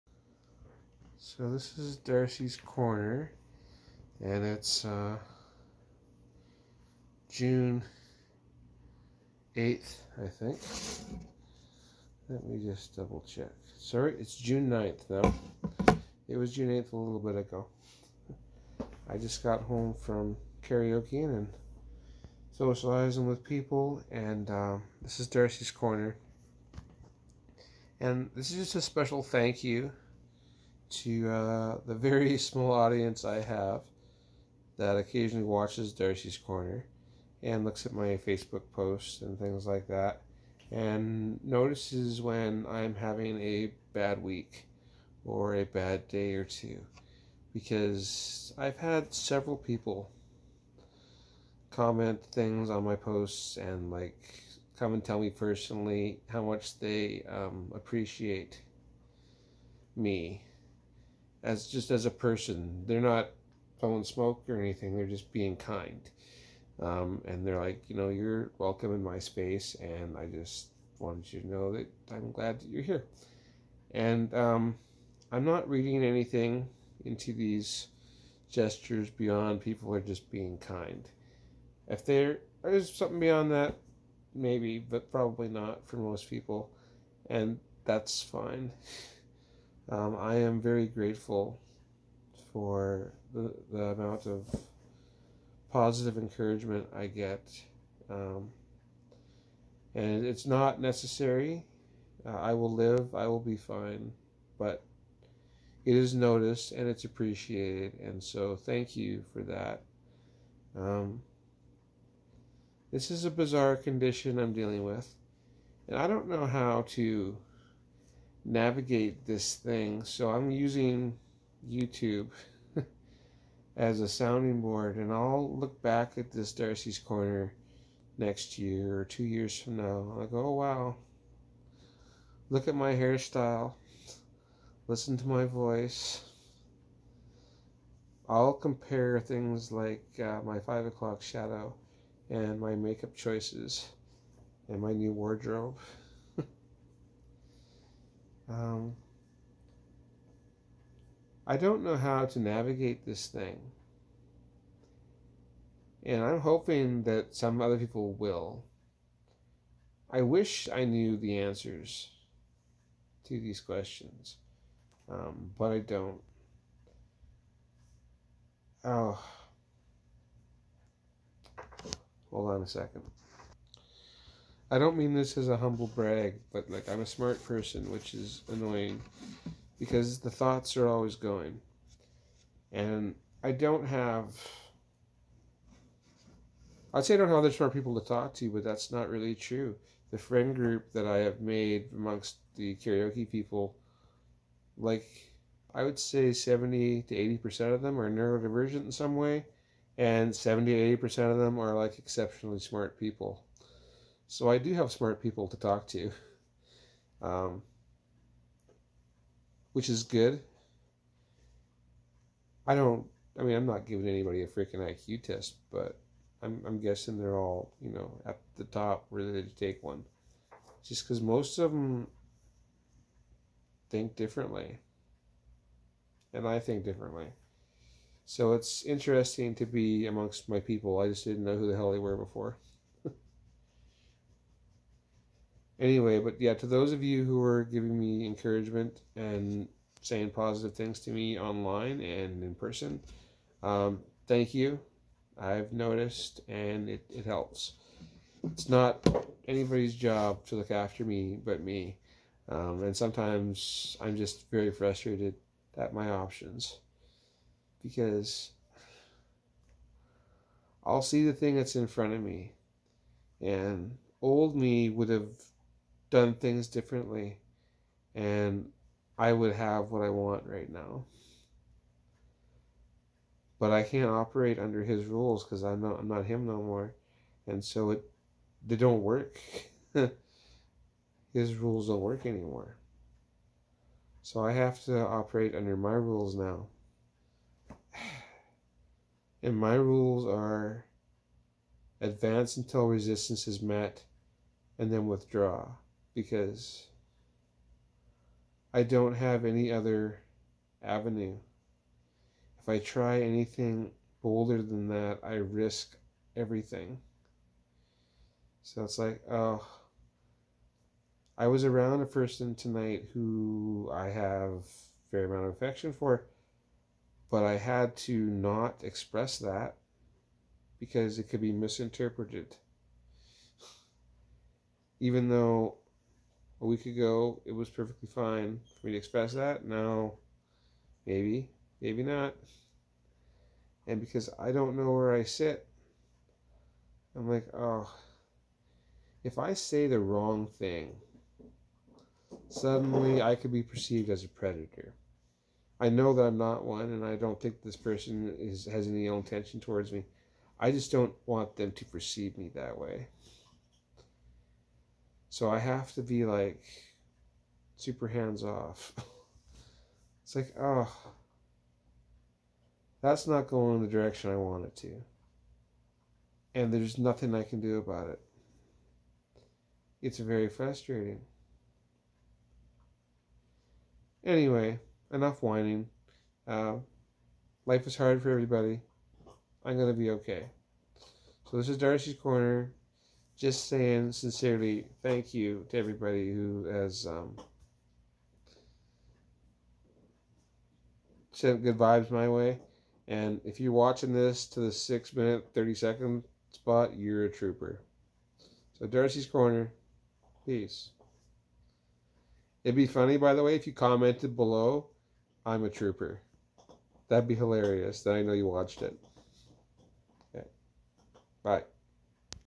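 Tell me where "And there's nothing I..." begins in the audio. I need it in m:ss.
6:06.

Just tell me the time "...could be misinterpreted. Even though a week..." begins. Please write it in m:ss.
5:21.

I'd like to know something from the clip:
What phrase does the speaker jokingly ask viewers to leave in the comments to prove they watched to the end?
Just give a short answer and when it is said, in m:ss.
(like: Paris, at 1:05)
I'm a trooper, at 6:45.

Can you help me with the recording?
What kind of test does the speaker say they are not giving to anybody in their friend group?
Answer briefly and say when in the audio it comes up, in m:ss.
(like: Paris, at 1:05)
IQ test, at 3:34.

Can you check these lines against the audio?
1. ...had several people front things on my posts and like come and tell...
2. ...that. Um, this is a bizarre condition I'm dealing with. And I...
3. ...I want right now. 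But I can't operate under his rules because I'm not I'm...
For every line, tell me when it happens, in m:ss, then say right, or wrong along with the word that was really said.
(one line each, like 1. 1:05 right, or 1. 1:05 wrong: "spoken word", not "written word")
1. 0:48 wrong: "comment", not "front"
2. 1:49 right
3. 4:30 right.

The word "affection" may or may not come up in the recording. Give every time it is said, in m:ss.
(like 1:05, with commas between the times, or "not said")
5:15.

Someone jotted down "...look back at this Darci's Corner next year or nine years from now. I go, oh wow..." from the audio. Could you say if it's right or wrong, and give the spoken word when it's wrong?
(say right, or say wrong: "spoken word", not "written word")
wrong: "two", not "nine".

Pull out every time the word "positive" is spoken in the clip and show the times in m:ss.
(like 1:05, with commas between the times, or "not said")
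1:35, 4:00.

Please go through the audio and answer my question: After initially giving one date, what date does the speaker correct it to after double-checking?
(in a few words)
June 9th.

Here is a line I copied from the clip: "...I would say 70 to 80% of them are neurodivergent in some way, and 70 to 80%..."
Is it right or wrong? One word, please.
right.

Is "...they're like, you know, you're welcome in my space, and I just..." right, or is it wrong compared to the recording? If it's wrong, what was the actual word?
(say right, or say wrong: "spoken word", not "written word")
right.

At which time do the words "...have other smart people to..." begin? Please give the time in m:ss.
3:07.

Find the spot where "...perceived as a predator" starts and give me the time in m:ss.
5:43.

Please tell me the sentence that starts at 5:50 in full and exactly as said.
I just don't want them to perceive me that way.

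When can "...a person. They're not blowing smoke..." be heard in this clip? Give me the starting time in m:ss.
1:02.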